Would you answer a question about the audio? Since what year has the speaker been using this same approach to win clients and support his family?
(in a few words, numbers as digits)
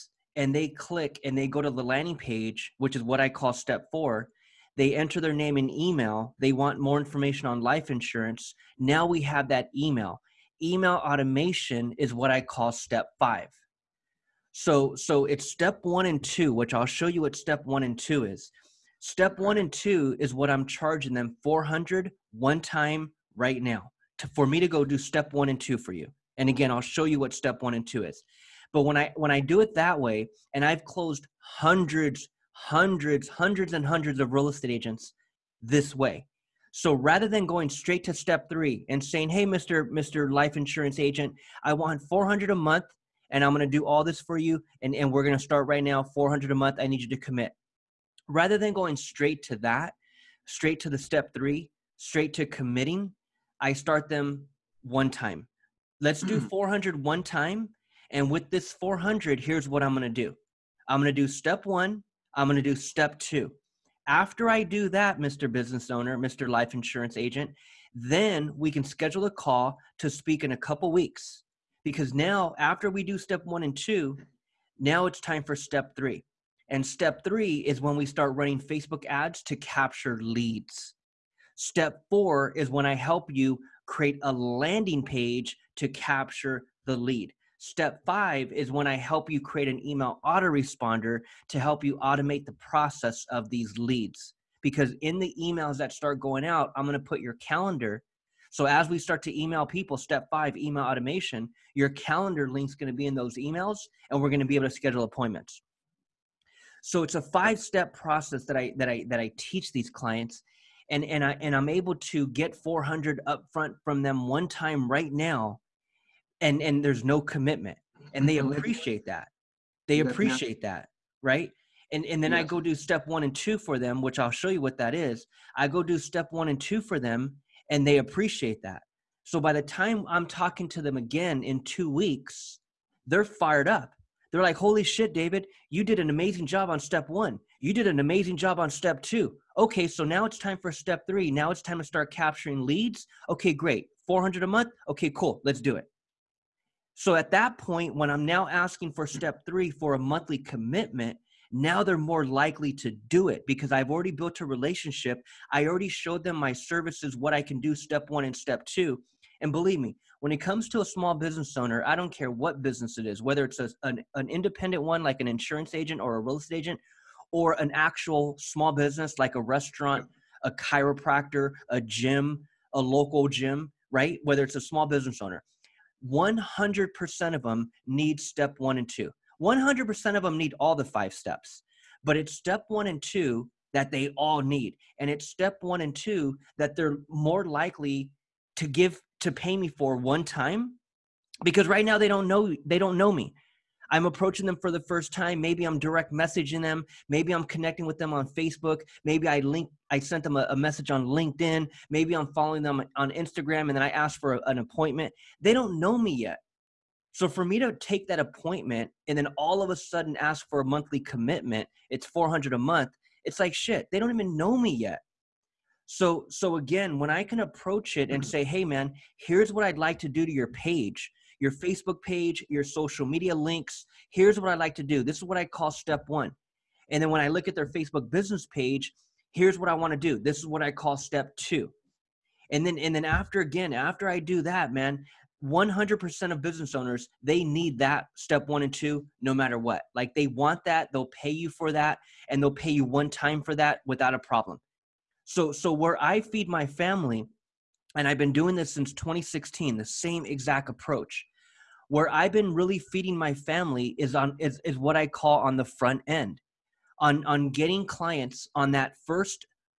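2016.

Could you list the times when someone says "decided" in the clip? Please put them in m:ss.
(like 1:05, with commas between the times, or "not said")
not said.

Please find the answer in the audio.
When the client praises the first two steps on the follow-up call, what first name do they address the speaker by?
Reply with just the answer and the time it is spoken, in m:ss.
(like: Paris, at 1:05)
David, at 2:15.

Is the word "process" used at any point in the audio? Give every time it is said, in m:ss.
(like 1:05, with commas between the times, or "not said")
1:32, 1:47.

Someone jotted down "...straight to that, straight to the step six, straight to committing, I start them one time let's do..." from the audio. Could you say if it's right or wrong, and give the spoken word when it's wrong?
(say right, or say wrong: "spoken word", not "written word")
wrong: "three", not "six".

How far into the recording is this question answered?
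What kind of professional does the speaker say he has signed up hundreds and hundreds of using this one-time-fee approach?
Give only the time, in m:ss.
0:34.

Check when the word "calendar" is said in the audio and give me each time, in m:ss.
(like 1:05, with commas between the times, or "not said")
1:37, 1:41.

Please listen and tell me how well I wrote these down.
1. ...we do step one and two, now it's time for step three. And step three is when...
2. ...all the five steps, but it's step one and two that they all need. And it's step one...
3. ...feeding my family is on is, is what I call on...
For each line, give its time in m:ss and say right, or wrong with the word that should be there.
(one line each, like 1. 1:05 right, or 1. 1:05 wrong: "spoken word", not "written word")
1. 1:12 right
2. 3:00 right
3. 4:12 right.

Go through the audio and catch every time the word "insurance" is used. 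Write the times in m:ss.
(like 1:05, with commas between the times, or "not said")
0:07, 0:40, 1:06, 2:45.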